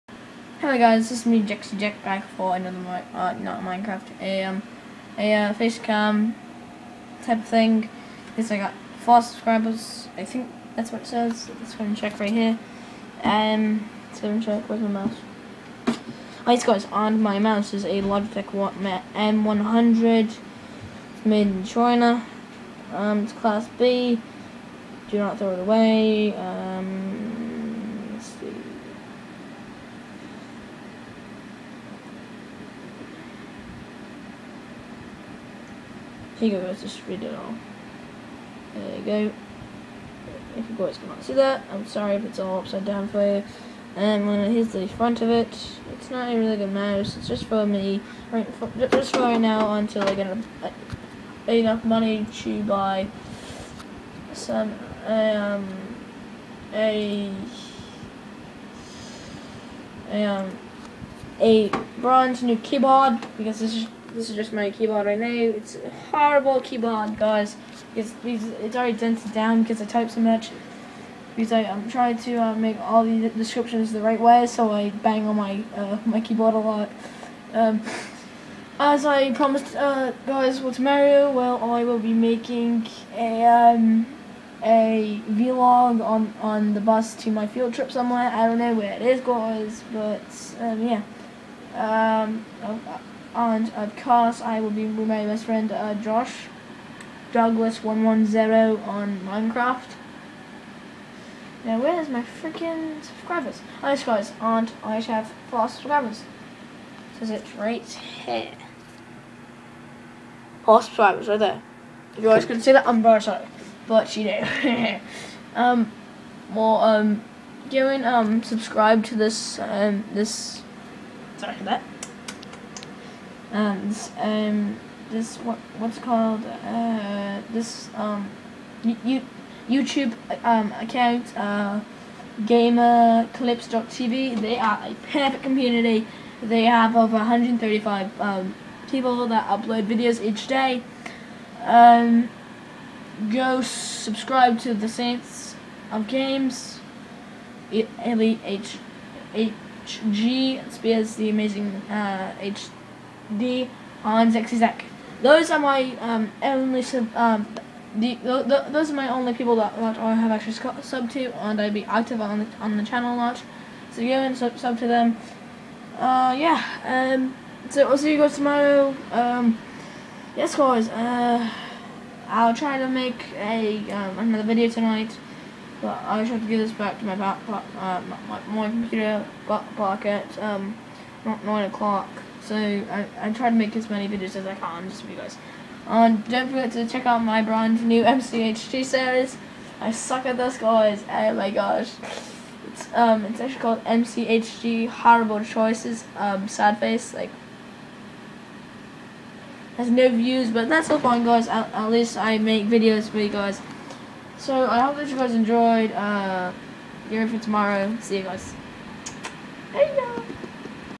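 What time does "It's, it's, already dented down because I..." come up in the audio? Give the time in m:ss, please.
1:07.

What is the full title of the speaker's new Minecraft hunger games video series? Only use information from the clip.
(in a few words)
MCHG Horrible Choices.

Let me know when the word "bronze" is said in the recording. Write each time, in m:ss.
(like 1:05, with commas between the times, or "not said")
1:01.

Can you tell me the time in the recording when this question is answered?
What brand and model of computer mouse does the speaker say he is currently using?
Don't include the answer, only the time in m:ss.
0:18.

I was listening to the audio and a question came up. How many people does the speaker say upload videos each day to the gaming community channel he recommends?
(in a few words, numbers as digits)
over 135.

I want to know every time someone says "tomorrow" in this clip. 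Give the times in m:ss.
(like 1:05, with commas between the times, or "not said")
1:20, 2:48, 3:27.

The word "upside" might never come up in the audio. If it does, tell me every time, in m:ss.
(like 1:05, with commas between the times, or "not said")
0:42.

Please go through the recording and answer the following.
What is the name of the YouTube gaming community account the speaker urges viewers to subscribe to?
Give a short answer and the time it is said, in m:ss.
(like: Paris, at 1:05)
gamerclips.tv, at 2:12.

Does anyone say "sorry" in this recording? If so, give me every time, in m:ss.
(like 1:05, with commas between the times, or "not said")
0:41, 1:53, 2:01.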